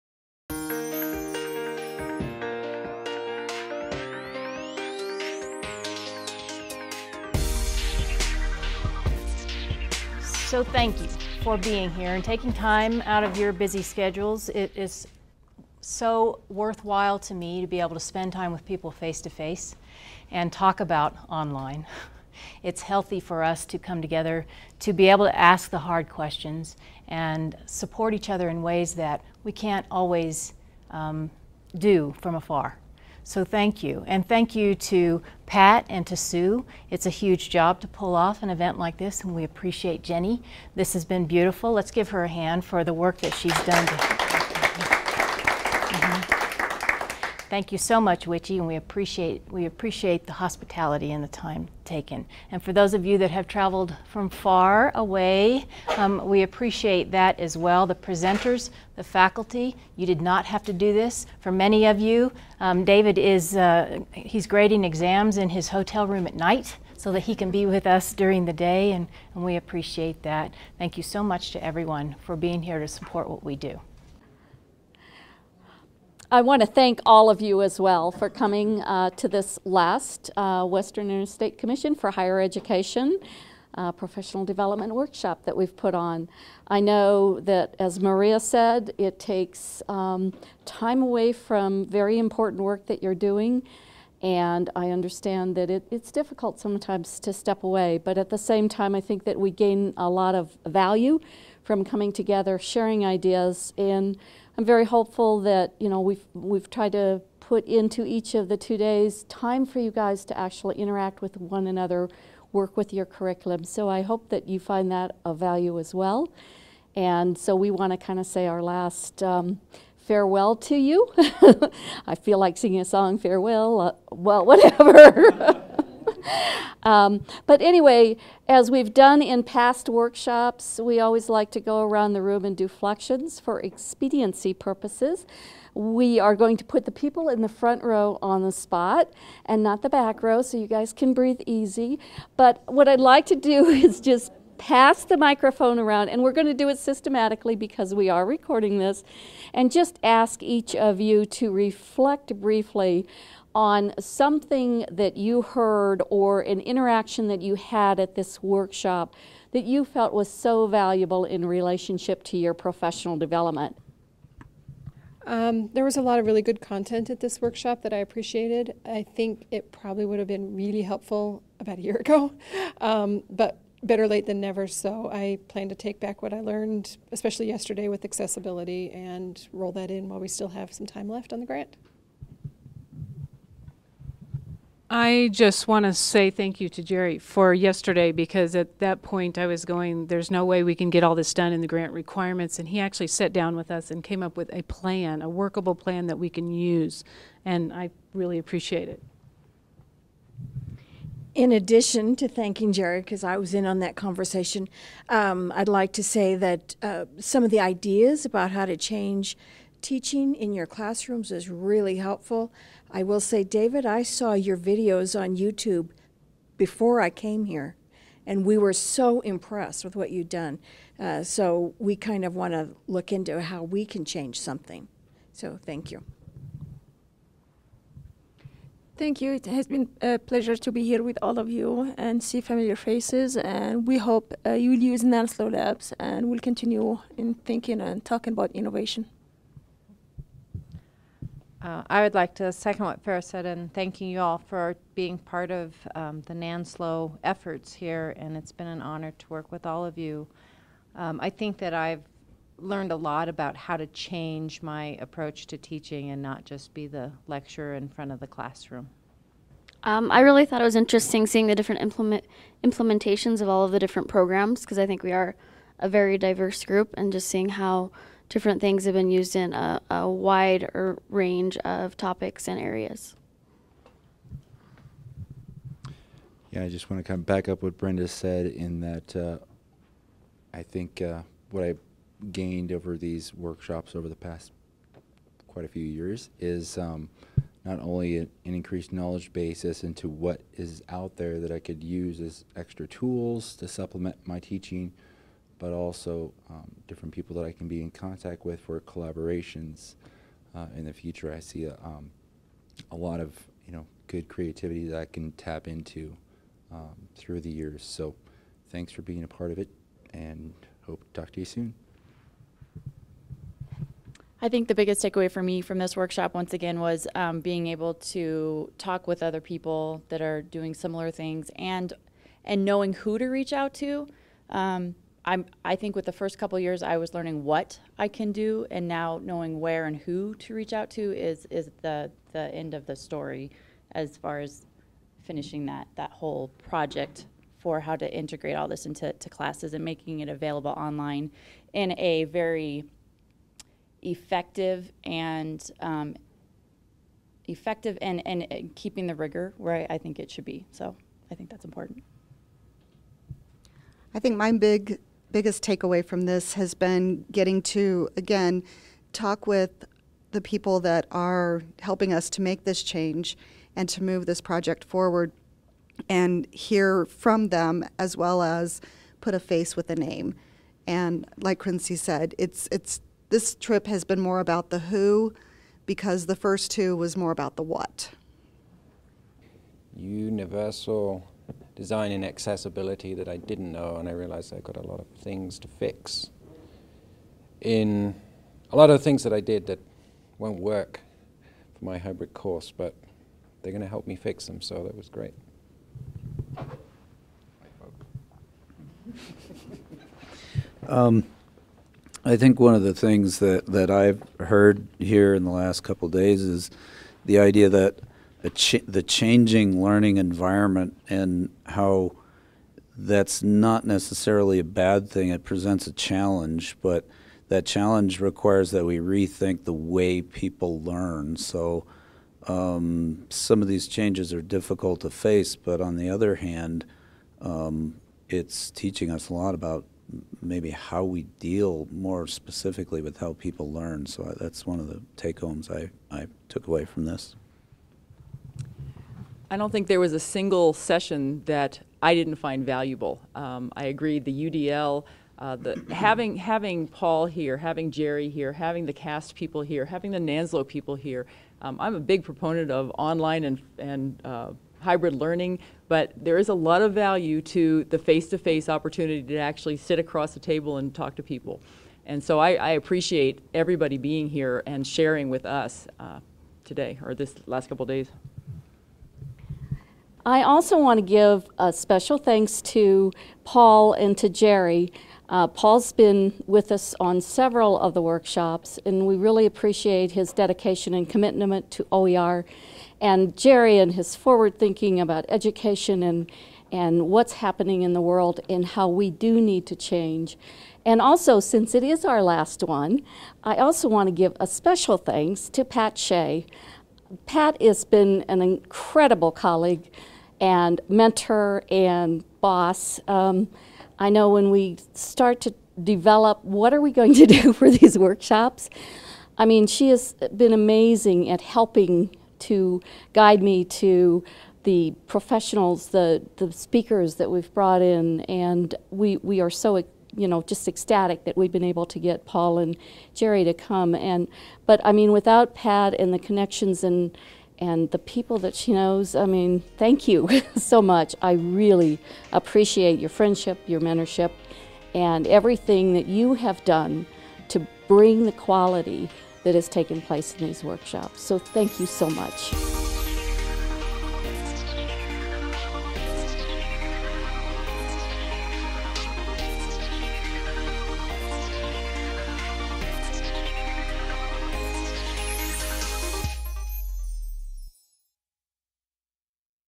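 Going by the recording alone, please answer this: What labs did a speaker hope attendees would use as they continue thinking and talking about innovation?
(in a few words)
NANSLO Labs.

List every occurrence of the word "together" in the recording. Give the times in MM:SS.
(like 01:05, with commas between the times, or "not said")
00:24, 01:42.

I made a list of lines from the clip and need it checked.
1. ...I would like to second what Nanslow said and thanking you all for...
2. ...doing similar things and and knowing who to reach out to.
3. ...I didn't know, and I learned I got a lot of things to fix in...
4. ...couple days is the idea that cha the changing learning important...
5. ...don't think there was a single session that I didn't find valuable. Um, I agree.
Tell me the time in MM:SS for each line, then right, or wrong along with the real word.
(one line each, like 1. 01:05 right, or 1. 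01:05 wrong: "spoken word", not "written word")
1. 04:01 wrong: "Farah", not "Nanslow"
2. 05:20 right
3. 06:23 wrong: "realized", not "learned"
4. 06:45 wrong: "environment", not "important"
5. 07:19 right.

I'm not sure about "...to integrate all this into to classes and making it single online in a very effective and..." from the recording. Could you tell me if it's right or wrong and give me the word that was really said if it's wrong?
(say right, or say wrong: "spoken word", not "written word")
wrong: "available", not "single".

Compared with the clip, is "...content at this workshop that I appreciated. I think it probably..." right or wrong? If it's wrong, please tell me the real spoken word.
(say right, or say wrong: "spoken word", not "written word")
right.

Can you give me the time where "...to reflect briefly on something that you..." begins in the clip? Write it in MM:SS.
02:31.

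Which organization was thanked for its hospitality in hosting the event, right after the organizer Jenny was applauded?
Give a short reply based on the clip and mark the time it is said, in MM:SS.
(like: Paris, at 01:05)
WICHE, at 00:48.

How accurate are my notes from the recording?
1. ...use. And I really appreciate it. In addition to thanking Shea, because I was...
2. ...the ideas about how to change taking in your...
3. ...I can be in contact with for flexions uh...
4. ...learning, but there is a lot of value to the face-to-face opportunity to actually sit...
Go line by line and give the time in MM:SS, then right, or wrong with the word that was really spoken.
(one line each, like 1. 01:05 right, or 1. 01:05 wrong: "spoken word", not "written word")
1. 03:16 wrong: "Jerry", not "Shea"
2. 03:27 wrong: "teaching", not "taking"
3. 04:57 wrong: "collaborations", not "flexions"
4. 07:35 right.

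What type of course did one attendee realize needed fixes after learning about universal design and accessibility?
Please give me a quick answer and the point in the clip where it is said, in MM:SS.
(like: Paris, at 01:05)
hybrid course, at 06:31.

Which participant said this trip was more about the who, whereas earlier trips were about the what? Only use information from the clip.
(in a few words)
Quincy.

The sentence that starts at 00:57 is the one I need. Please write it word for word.
The presenters, the faculty, you did not have to do this.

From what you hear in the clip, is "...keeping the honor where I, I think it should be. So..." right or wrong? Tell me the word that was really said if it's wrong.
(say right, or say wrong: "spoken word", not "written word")
wrong: "rigor", not "honor".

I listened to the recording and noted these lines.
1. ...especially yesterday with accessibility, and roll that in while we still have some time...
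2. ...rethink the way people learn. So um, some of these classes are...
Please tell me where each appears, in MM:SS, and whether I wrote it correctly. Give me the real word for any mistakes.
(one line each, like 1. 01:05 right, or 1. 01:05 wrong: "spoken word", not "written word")
1. 02:57 right
2. 06:58 wrong: "changes", not "classes".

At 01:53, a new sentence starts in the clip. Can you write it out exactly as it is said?
So I hope that you find that of value as well.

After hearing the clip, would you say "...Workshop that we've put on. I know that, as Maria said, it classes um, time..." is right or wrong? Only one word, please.
wrong.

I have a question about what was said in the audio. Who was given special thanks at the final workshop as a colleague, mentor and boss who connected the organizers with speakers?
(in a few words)
Pat Shea.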